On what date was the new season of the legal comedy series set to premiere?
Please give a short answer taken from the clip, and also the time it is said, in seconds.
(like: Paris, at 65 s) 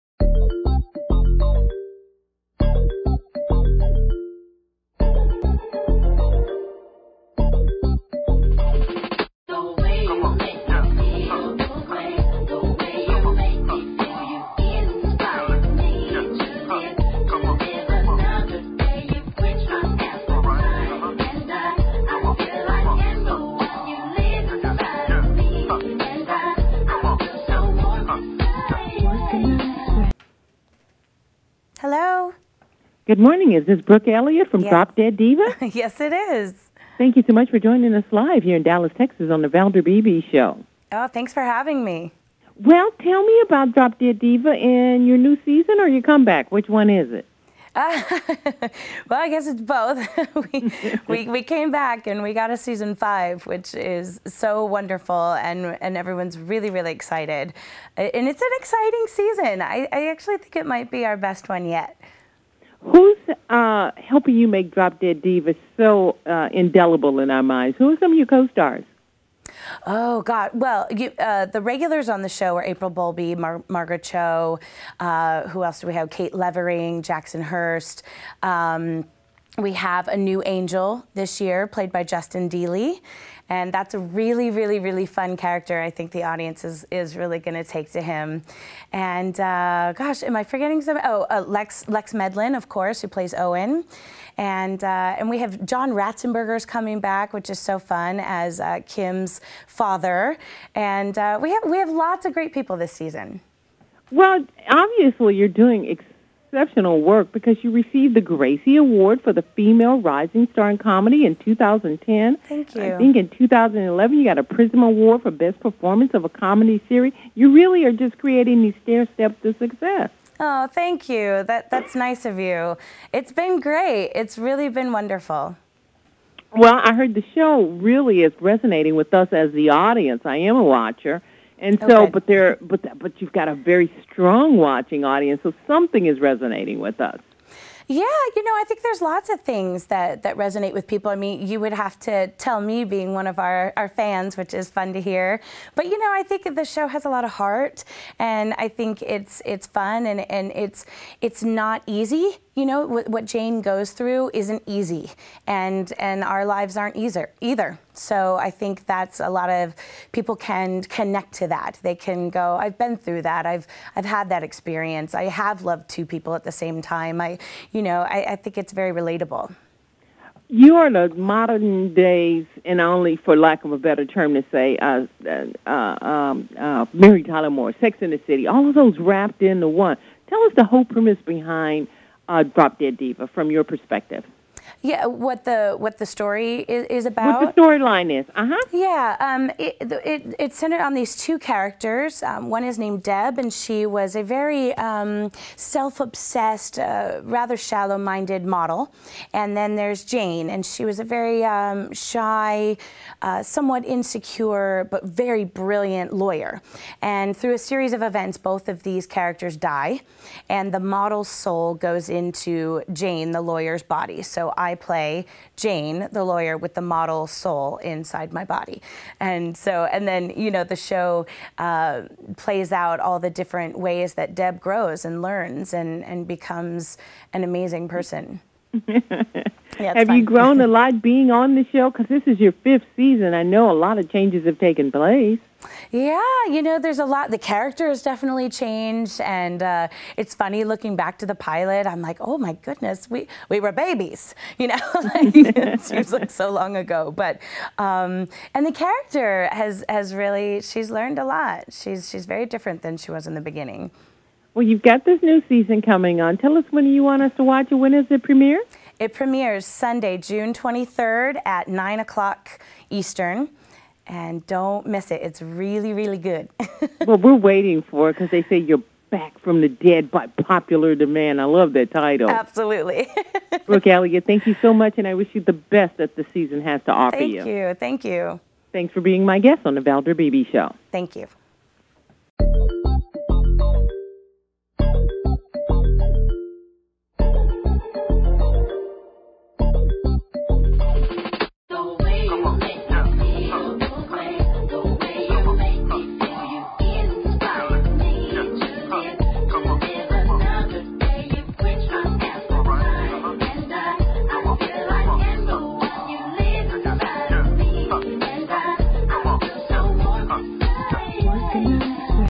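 Sunday, June 23rd, at 259 s.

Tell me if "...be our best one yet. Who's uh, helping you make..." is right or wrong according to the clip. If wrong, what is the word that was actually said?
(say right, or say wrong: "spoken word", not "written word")
right.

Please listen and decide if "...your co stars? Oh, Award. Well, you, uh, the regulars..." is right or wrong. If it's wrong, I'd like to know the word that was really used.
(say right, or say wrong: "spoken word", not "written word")
wrong: "God", not "Award".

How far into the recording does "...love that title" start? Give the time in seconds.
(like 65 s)
271 s.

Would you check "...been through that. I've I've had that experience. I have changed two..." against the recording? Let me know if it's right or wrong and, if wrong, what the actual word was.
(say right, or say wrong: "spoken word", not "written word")
wrong: "loved", not "changed".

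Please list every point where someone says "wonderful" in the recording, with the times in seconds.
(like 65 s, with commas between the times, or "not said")
54 s, 124 s.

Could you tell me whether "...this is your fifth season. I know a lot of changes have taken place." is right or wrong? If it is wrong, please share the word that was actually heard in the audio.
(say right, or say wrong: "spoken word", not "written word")
right.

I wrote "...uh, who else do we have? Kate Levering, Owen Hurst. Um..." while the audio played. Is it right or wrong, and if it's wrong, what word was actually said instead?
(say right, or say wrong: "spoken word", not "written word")
wrong: "Jackson", not "Owen".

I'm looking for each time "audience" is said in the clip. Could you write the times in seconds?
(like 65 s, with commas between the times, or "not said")
86 s, 129 s, 135 s.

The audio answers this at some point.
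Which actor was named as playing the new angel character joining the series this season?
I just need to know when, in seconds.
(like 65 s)
82 s.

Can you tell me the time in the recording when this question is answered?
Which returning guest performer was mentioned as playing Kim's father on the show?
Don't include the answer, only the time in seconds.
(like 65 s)
95 s.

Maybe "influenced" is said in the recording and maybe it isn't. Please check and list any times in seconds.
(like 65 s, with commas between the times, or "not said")
not said.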